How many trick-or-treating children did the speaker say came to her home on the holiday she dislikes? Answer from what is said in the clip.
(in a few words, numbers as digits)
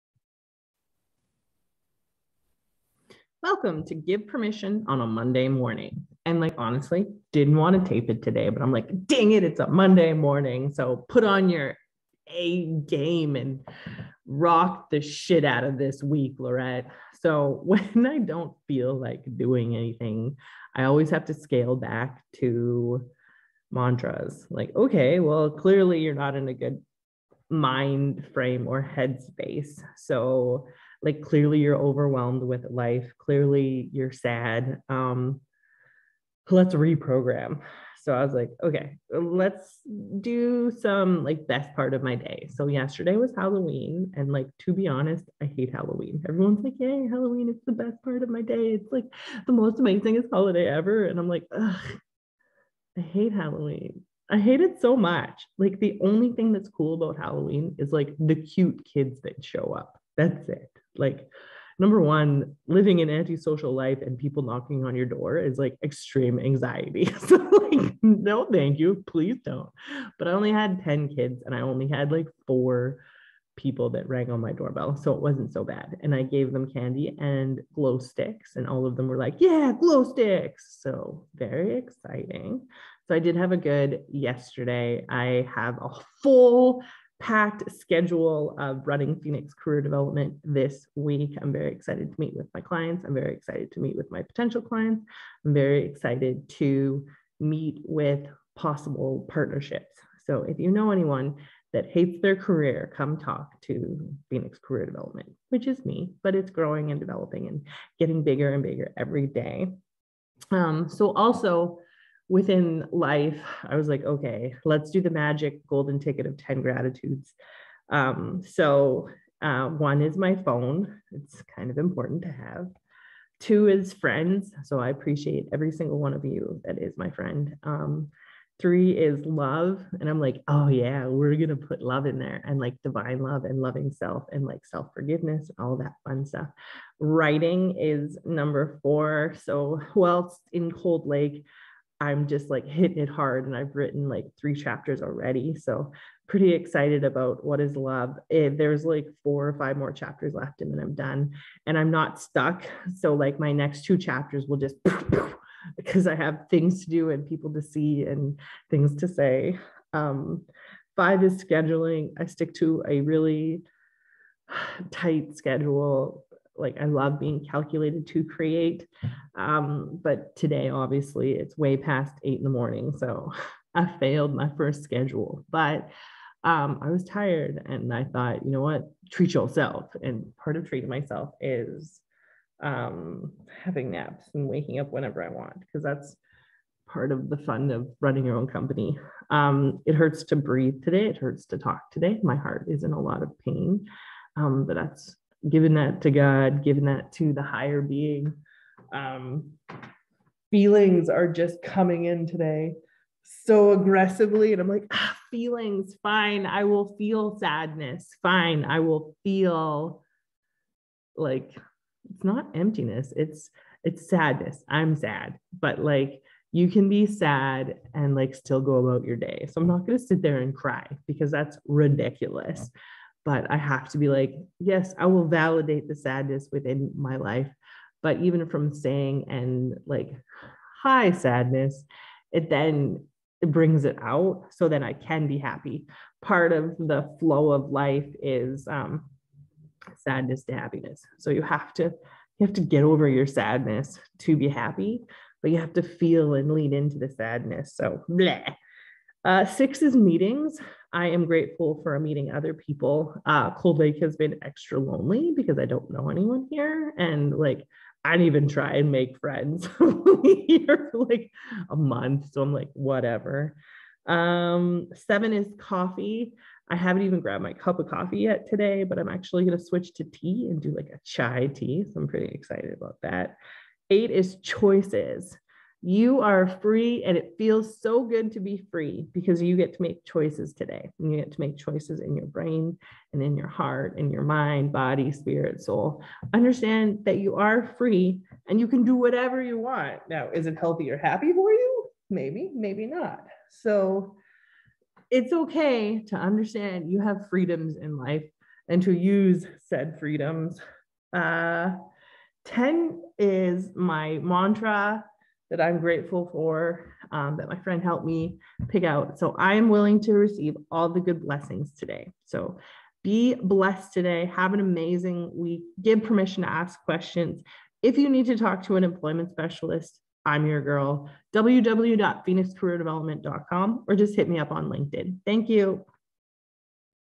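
10.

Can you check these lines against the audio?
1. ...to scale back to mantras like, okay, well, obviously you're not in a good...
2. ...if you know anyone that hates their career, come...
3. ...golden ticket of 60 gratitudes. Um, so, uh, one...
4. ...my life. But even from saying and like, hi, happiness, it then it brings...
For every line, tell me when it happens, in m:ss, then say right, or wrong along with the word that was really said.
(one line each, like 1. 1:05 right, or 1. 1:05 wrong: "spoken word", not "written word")
1. 0:21 wrong: "clearly", not "obviously"
2. 1:40 right
3. 1:55 wrong: "10", not "60"
4. 3:46 wrong: "sadness", not "happiness".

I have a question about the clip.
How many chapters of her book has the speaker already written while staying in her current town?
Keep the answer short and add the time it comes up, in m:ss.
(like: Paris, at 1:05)
3, at 2:24.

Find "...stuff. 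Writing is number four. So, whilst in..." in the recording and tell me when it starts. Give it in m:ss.
2:16.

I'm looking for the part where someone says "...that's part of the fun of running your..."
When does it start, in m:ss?
3:05.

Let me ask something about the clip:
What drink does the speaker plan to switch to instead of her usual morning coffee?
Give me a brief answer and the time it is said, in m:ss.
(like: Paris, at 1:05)
Chai tea, at 4:31.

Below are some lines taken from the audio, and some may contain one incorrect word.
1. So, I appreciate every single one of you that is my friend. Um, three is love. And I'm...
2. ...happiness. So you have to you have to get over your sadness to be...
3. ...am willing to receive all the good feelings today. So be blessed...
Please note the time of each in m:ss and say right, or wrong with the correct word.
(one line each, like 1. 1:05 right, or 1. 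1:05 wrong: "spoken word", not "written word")
1. 2:04 right
2. 4:00 right
3. 5:09 wrong: "blessings", not "feelings".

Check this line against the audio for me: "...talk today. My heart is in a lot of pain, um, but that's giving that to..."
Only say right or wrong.
right.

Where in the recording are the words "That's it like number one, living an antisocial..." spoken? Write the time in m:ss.
1:00.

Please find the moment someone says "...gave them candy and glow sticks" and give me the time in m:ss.
1:16.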